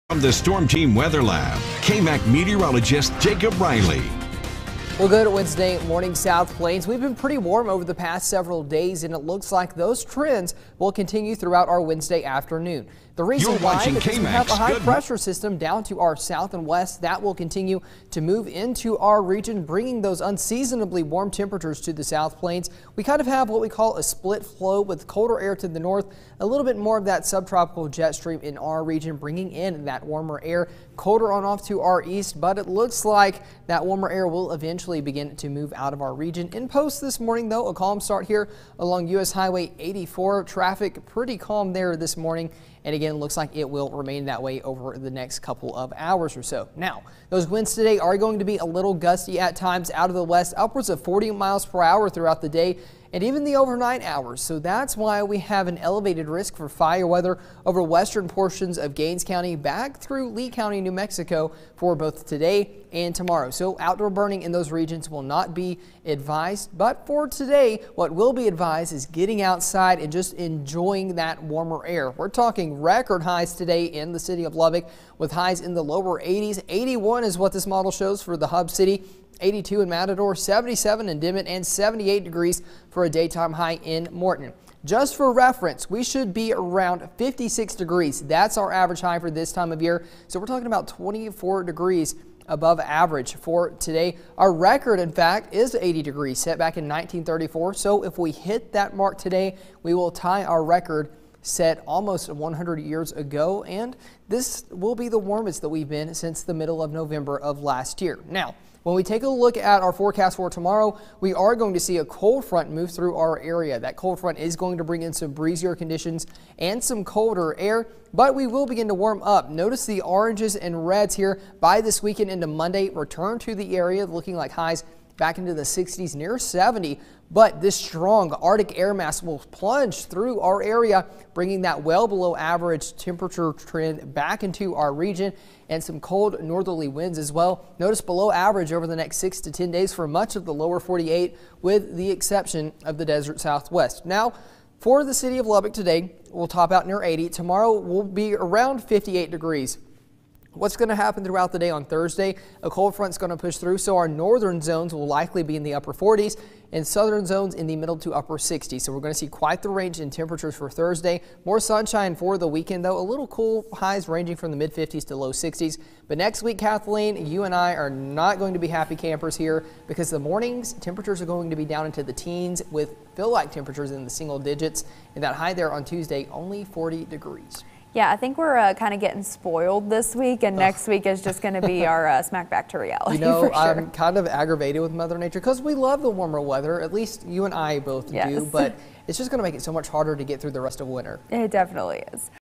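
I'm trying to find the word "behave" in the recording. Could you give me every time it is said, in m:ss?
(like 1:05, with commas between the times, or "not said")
not said.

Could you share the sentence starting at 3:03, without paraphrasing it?
I'm kind of aggravated with Mother Nature because we love the warmer weather.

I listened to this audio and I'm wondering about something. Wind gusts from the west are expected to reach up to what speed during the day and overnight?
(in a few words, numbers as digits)
40 mph.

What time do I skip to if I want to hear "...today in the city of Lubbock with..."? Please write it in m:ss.
1:13.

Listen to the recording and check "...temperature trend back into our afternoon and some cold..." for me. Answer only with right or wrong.
wrong.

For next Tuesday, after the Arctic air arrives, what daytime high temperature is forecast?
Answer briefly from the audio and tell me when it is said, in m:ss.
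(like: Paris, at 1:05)
40 degrees, at 2:56.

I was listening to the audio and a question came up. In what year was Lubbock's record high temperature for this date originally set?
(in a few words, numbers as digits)
1934.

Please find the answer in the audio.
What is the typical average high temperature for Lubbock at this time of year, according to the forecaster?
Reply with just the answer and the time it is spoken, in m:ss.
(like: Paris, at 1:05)
56 degrees, at 1:27.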